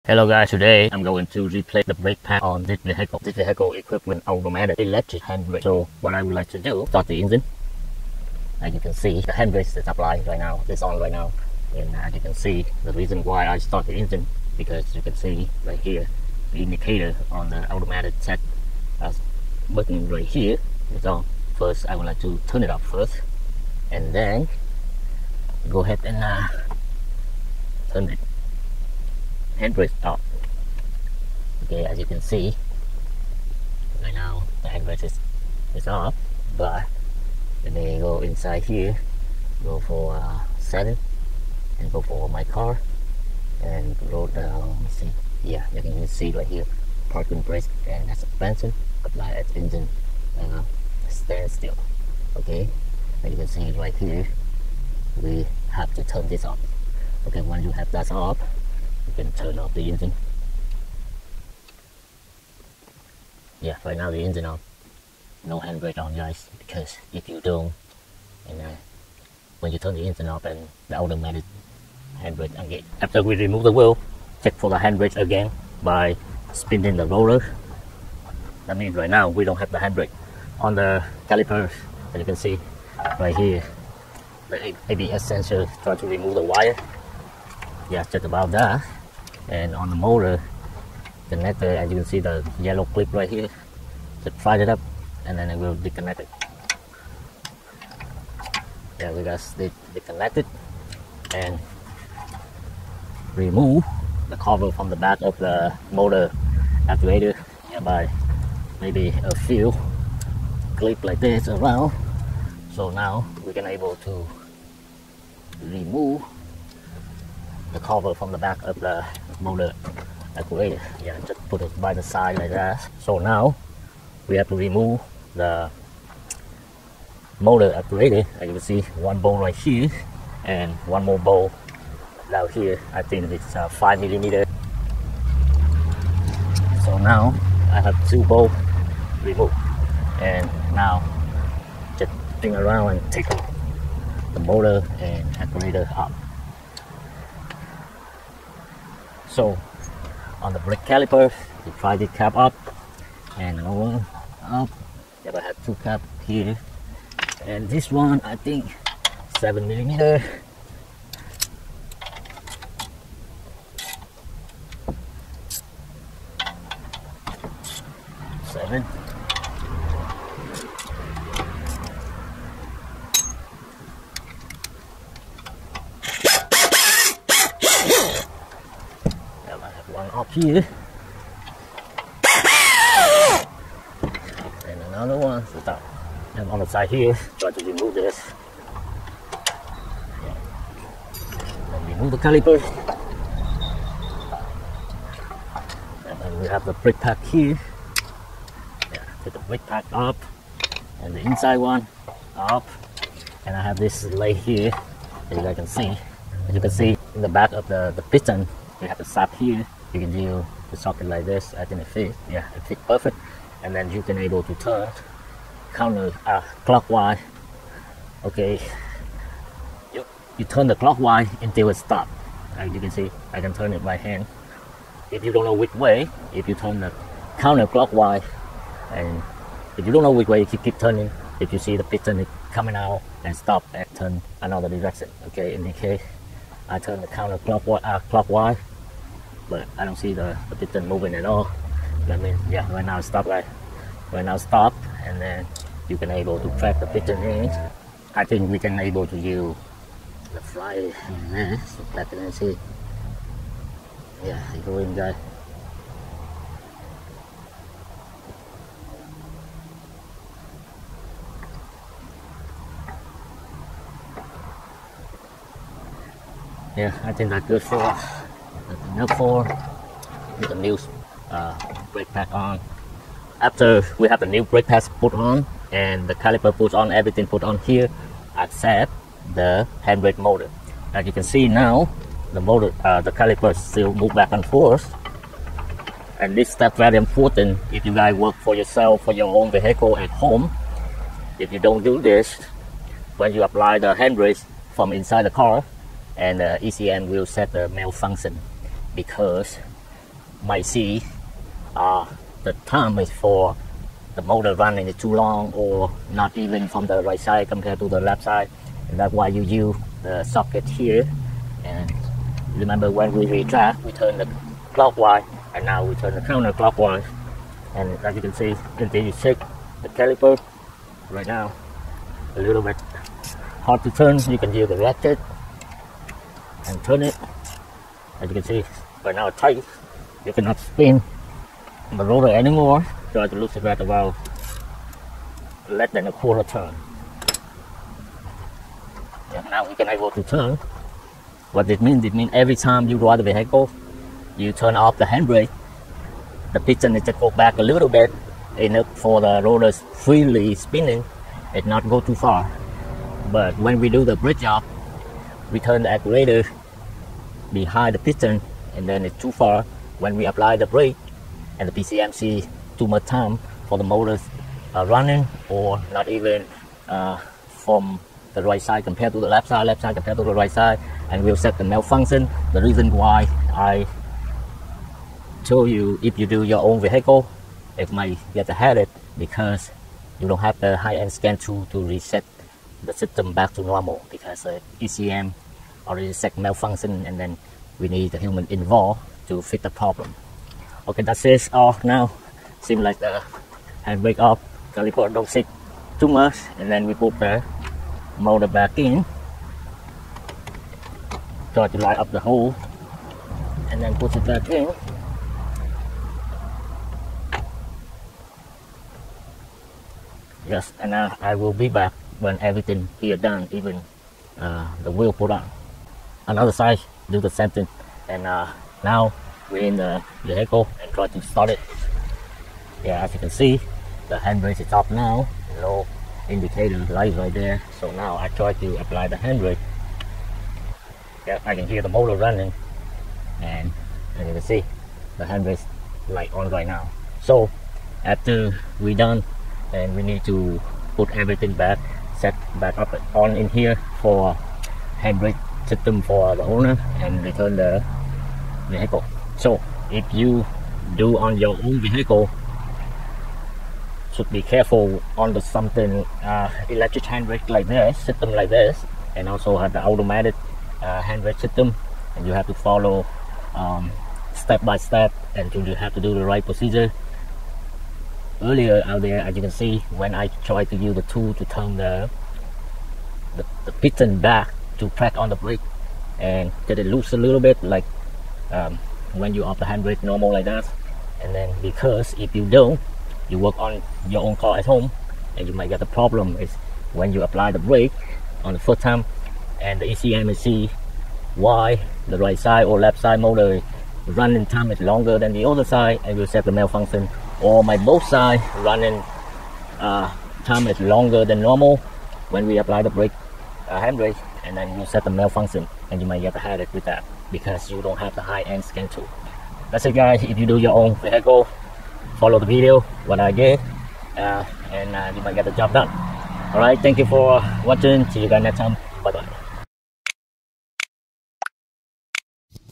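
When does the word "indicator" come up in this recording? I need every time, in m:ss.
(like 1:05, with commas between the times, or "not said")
0:16, 7:06.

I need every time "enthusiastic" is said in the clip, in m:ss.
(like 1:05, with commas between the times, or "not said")
not said.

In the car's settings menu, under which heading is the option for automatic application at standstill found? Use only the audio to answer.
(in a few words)
Parking brake and suspension.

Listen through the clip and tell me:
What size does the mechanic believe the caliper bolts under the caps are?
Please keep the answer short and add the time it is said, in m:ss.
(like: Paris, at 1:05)
7 millimeter, at 2:39.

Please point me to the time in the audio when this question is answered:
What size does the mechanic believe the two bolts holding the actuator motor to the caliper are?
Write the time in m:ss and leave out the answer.
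2:13.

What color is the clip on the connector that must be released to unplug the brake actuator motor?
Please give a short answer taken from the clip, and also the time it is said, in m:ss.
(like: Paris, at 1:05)
Yellow, at 1:32.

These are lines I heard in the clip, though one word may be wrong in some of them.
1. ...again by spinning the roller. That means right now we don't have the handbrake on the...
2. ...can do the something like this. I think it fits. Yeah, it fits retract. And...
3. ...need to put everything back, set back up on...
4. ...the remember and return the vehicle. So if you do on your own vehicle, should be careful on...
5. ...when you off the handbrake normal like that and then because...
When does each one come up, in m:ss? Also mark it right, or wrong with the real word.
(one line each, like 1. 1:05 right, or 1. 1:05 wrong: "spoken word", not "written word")
1. 1:15 right
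2. 3:29 wrong: "perfect", not "retract"
3. 7:20 right
4. 7:26 wrong: "owner", not "remember"
5. 7:59 right.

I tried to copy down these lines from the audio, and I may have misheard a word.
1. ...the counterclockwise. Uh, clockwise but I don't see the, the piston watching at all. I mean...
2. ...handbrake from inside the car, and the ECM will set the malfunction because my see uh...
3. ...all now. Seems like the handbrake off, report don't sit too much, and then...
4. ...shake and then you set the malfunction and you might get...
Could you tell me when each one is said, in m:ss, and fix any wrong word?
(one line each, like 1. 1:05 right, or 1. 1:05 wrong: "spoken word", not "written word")
1. 3:57 wrong: "moving", not "watching"
2. 4:53 right
3. 6:31 right
4. 8:23 wrong: "handbrake", not "shake".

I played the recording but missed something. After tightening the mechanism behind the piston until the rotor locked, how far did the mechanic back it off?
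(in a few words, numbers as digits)
Less than a quarter turn.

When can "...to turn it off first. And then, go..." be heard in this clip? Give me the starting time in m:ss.
0:22.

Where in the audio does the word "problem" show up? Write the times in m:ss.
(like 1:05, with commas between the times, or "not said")
6:29, 8:05.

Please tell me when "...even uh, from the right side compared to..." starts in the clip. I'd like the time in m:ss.
6:06.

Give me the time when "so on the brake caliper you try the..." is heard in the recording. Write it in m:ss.
2:29.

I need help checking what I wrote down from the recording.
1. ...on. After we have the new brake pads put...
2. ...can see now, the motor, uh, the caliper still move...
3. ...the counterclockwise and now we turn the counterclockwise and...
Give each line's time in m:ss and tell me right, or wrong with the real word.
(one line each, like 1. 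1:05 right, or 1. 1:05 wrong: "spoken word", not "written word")
1. 4:32 right
2. 4:41 right
3. 5:14 wrong: "clockwise", not "counterclockwise".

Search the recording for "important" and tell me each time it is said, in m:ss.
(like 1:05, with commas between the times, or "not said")
4:46.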